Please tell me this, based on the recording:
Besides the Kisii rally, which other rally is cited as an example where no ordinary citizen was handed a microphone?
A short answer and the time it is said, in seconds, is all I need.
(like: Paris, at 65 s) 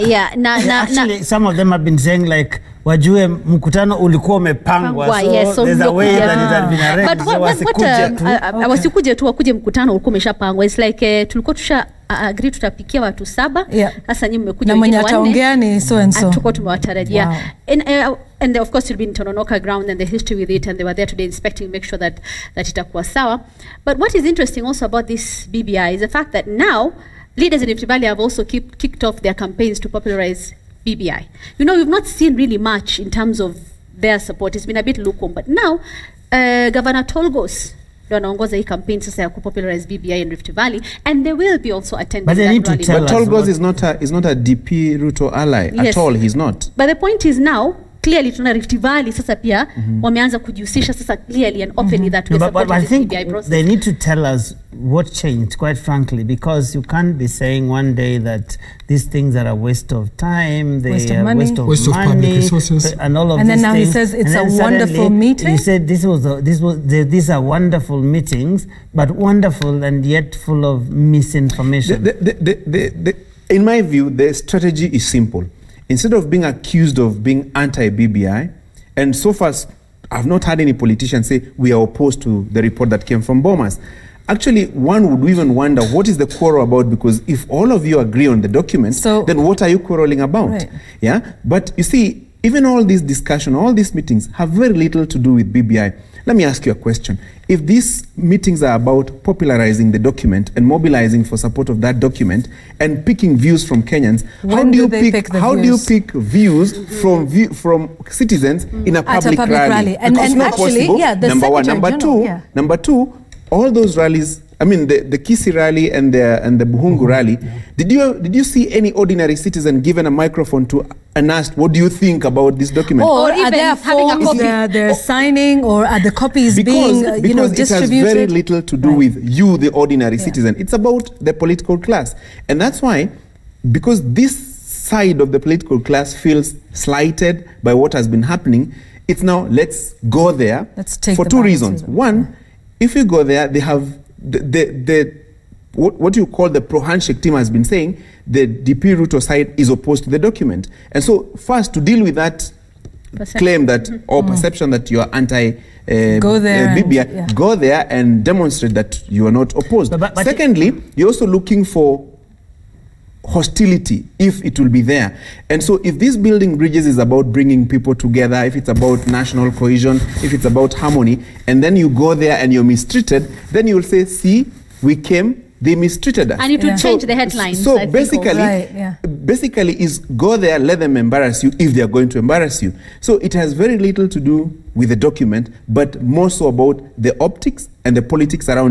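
Bukhungu, at 116 s.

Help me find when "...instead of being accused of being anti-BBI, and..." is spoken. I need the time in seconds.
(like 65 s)
75 s.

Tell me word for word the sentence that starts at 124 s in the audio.
signing or are the copies because, being, uh, you know, distributed?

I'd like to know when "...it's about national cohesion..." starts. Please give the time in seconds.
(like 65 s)
168 s.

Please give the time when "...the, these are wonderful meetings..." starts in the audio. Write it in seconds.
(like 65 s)
66 s.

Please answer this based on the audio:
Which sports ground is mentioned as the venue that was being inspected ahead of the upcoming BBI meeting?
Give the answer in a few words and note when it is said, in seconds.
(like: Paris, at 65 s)
Tononoka ground, at 19 s.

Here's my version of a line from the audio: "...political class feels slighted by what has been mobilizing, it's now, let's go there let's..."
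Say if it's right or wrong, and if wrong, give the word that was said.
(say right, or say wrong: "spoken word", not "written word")
wrong: "happening", not "mobilizing".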